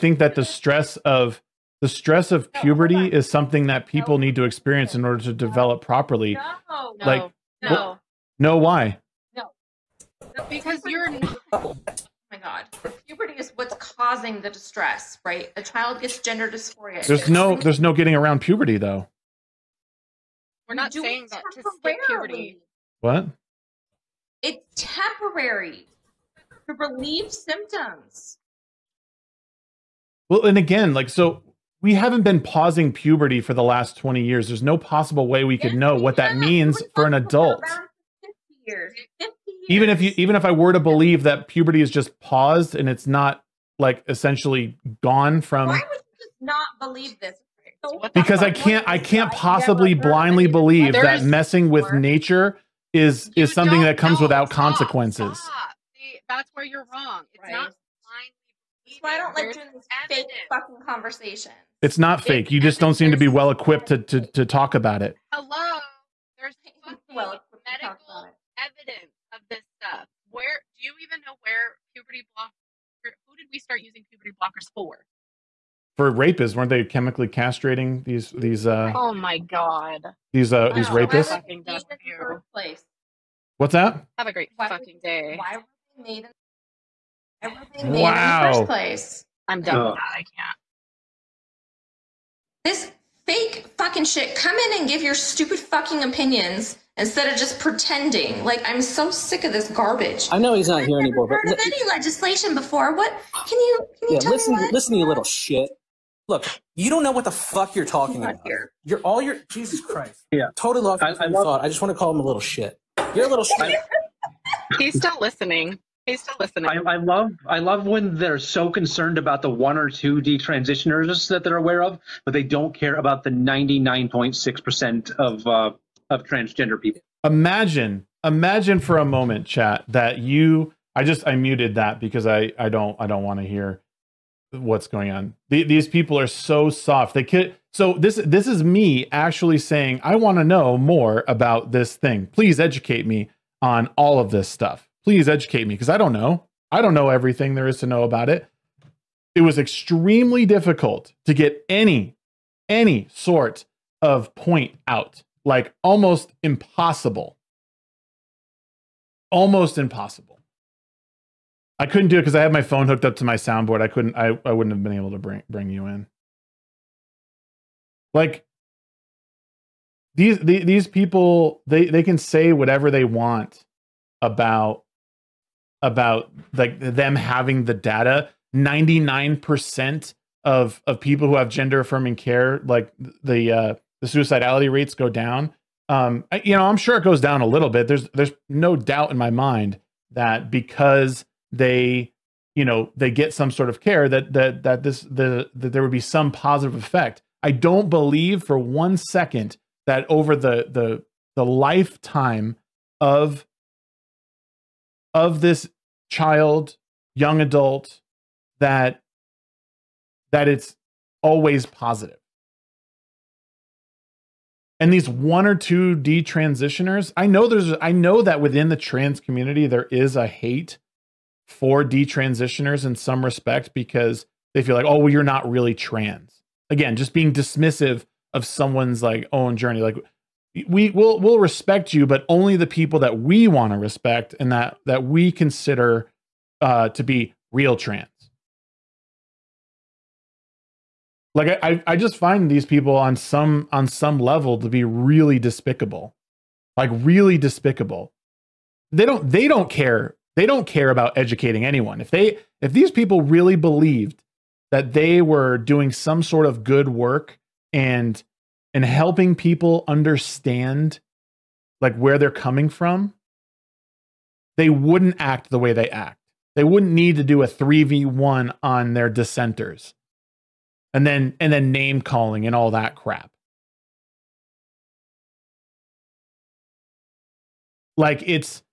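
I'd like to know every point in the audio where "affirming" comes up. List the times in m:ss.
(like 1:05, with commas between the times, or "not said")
3:01.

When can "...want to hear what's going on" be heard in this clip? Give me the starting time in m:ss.
2:13.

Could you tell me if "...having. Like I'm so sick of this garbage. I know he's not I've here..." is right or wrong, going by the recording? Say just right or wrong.
wrong.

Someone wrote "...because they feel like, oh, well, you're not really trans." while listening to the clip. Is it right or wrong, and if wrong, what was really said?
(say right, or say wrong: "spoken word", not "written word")
right.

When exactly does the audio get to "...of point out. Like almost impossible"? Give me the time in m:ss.
2:34.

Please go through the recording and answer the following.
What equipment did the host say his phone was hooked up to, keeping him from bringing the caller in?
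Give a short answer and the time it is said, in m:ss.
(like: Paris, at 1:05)
soundboard, at 2:43.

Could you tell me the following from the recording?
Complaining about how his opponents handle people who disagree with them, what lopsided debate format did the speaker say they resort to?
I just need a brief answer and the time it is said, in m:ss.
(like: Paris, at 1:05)
3v1, at 4:27.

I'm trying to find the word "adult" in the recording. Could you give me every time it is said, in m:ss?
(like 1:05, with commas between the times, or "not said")
0:37, 3:27.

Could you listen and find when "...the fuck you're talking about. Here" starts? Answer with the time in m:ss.
1:47.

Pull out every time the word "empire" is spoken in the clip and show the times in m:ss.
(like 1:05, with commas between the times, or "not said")
not said.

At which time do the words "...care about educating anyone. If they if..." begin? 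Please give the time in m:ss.
4:10.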